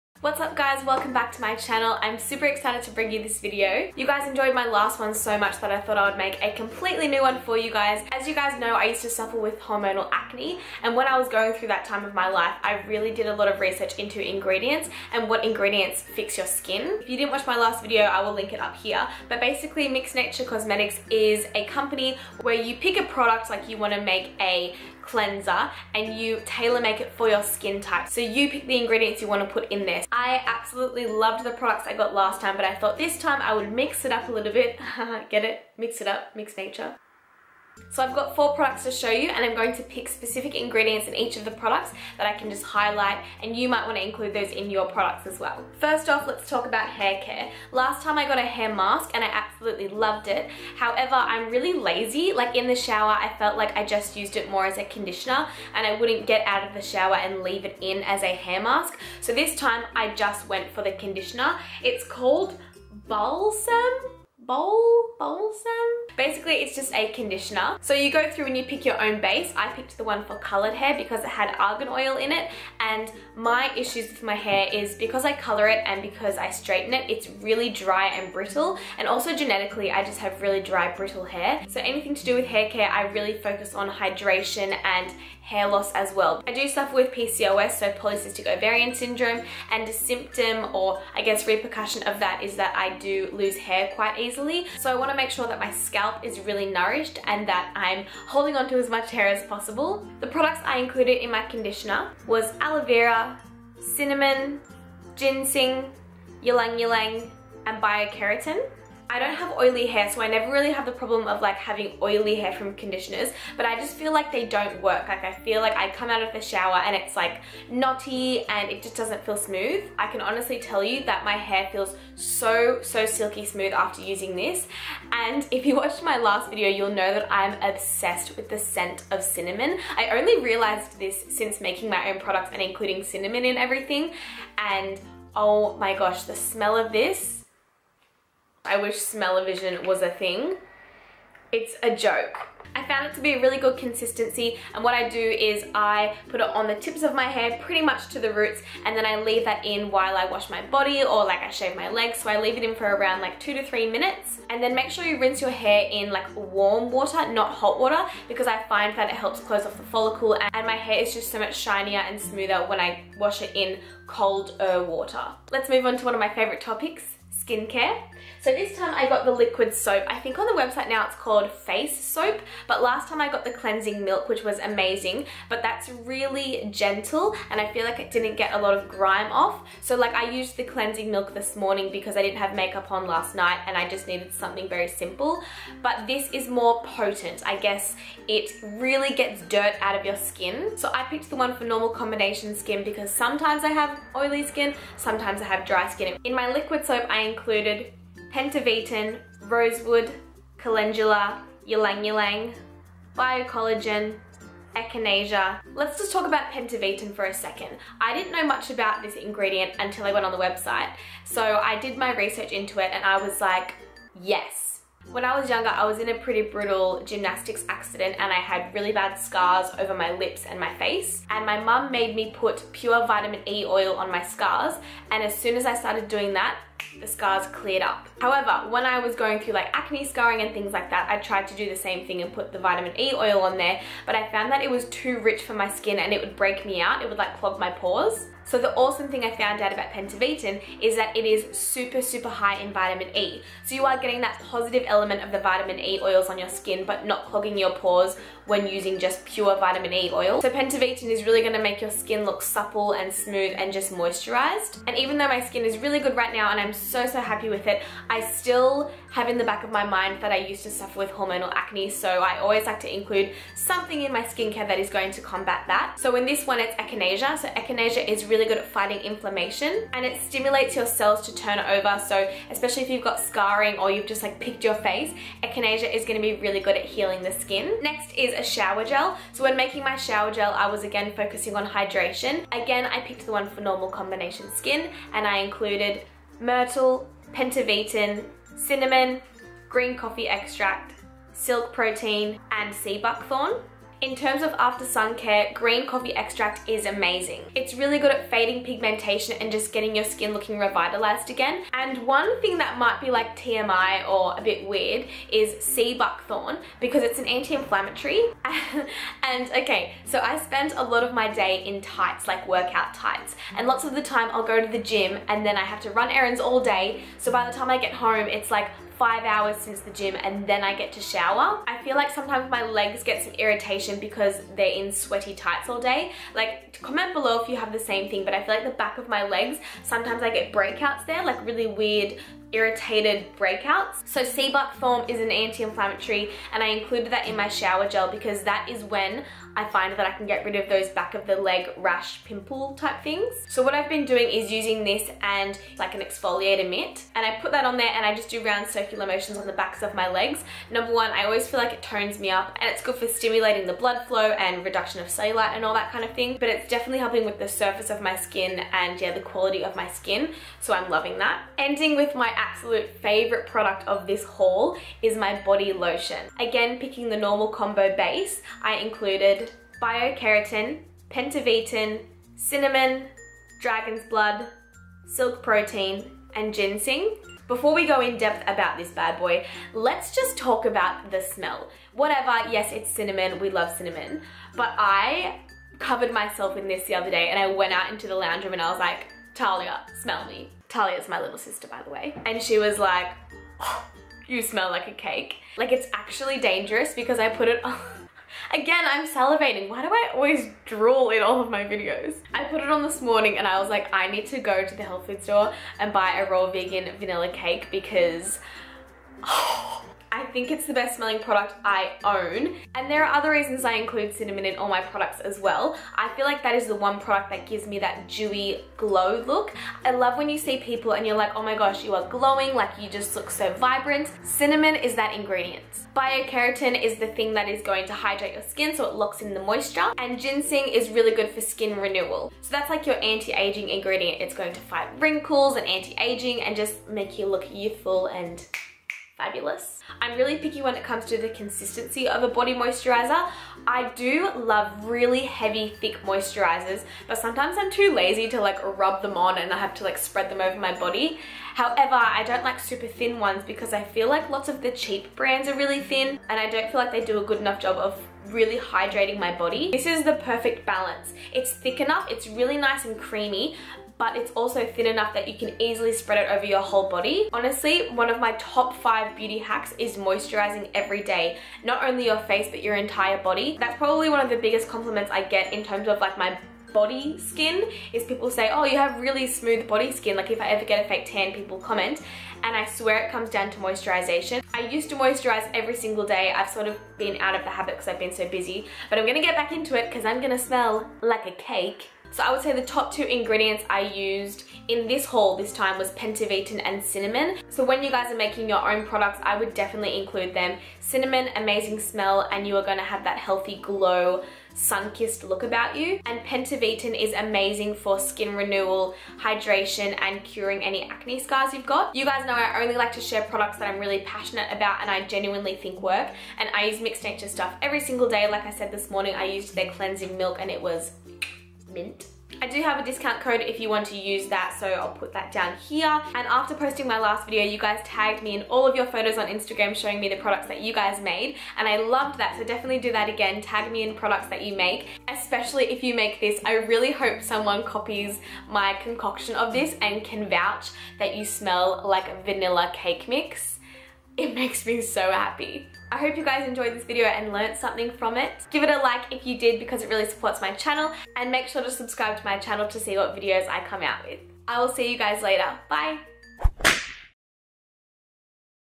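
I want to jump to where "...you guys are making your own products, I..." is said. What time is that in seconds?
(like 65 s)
497 s.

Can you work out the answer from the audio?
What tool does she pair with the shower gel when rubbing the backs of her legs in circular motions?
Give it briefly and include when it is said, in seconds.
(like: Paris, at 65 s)
Exfoliator mitt, at 346 s.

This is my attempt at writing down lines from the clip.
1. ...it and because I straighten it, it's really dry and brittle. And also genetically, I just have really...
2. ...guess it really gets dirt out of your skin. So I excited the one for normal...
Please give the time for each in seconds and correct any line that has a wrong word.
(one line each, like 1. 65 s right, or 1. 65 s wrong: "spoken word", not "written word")
1. 75 s right
2. 187 s wrong: "picked", not "excited".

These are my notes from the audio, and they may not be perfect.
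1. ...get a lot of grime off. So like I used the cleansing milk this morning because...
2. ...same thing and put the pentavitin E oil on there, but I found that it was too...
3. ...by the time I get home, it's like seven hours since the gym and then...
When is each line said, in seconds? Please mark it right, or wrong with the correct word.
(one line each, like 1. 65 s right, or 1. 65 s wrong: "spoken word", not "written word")
1. 178 s right
2. 231 s wrong: "vitamin", not "pentavitin"
3. 317 s wrong: "five", not "seven".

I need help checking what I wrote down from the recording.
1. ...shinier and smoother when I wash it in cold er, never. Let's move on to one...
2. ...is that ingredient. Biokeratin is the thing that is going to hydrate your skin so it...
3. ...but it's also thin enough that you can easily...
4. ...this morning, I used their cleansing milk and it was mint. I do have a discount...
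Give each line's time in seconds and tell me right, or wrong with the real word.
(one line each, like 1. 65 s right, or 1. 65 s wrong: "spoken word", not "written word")
1. 161 s wrong: "water", not "never"
2. 424 s right
3. 464 s right
4. 518 s right.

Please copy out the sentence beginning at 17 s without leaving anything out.
If you didn't watch my last video, I will link it up here.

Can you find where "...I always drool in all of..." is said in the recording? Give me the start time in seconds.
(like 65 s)
399 s.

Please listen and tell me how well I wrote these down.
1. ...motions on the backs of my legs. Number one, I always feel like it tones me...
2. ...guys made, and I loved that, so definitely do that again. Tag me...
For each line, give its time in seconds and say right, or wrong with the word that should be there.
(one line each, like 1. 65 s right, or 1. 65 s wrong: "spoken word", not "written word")
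1. 349 s right
2. 530 s right.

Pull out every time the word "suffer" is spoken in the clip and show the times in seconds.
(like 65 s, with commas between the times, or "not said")
9 s, 86 s, 260 s.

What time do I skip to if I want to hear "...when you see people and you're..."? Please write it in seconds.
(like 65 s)
420 s.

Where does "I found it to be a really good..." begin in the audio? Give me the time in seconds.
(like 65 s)
142 s.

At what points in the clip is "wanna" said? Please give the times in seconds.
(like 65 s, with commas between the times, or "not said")
23 s, 94 s.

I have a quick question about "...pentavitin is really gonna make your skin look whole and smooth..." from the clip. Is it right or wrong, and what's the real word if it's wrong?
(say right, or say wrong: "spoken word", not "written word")
wrong: "supple", not "whole".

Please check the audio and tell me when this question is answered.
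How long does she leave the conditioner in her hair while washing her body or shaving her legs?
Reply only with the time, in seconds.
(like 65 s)
153 s.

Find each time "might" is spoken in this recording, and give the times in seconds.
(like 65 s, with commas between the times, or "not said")
43 s, 302 s.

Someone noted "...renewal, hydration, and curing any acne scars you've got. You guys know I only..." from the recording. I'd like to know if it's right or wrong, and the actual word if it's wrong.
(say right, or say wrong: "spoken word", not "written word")
right.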